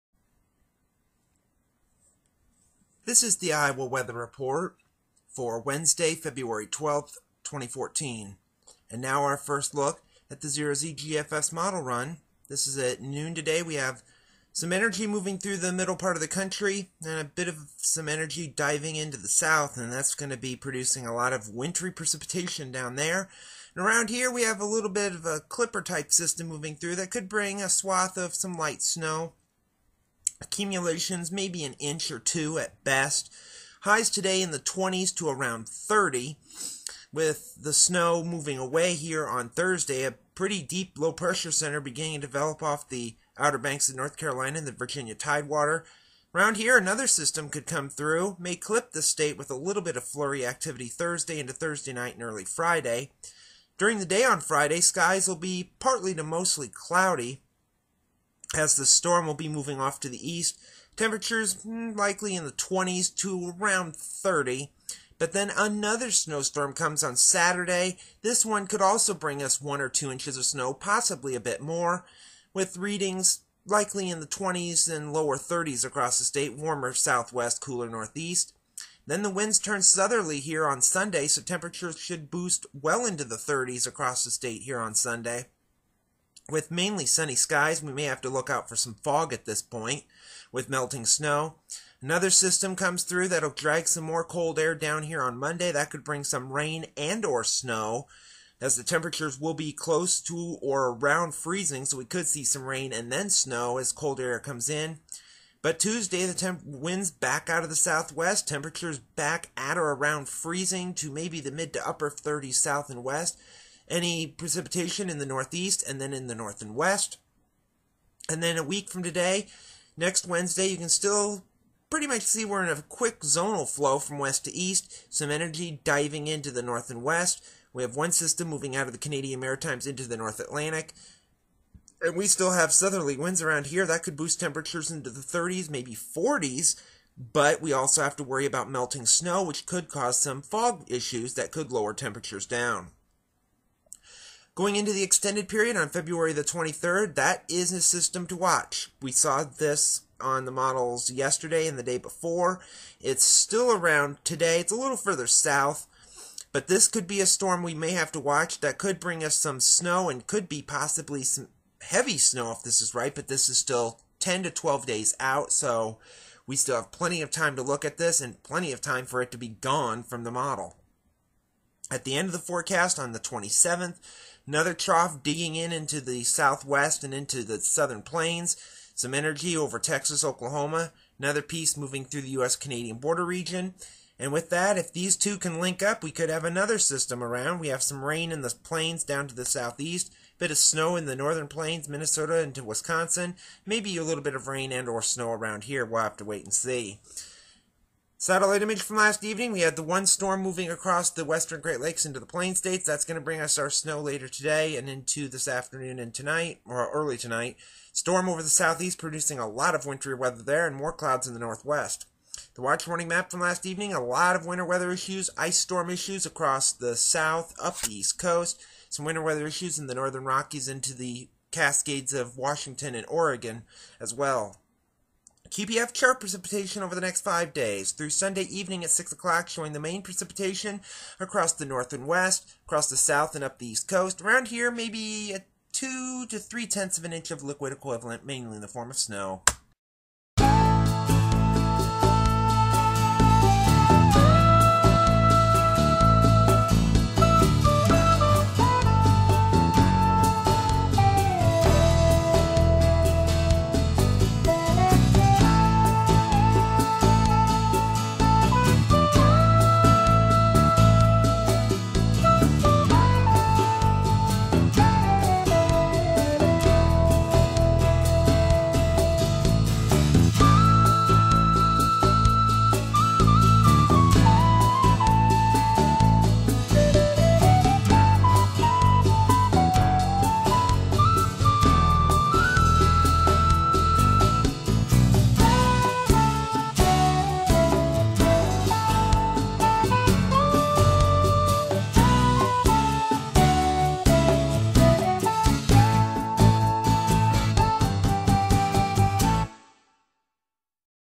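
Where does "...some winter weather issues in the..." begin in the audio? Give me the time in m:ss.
3:38.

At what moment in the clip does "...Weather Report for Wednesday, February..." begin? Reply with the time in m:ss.
0:03.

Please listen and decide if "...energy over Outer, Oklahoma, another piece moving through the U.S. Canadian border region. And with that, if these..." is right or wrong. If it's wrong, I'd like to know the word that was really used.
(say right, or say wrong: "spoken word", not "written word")
wrong: "Texas", not "Outer".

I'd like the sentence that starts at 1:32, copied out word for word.
Another system comes through that'll drag some more cold air down here on Monday.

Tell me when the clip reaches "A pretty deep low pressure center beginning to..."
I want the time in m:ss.
0:40.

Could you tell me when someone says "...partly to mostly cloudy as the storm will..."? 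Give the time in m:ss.
0:55.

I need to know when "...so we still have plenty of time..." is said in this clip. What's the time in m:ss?
2:45.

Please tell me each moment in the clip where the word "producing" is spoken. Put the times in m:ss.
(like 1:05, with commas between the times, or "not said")
0:20, 3:28.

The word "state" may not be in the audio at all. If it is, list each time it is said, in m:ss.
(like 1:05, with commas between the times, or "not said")
0:49, 1:16, 1:24, 3:22.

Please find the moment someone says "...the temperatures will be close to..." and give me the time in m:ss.
1:38.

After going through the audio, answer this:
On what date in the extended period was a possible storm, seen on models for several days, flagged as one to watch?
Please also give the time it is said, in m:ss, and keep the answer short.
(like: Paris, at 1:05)
February 23, at 2:25.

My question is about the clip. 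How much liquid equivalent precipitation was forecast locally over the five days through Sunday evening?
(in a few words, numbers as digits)
2 to 3 tenths of an inch.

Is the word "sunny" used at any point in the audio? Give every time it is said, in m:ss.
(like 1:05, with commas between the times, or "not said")
1:27.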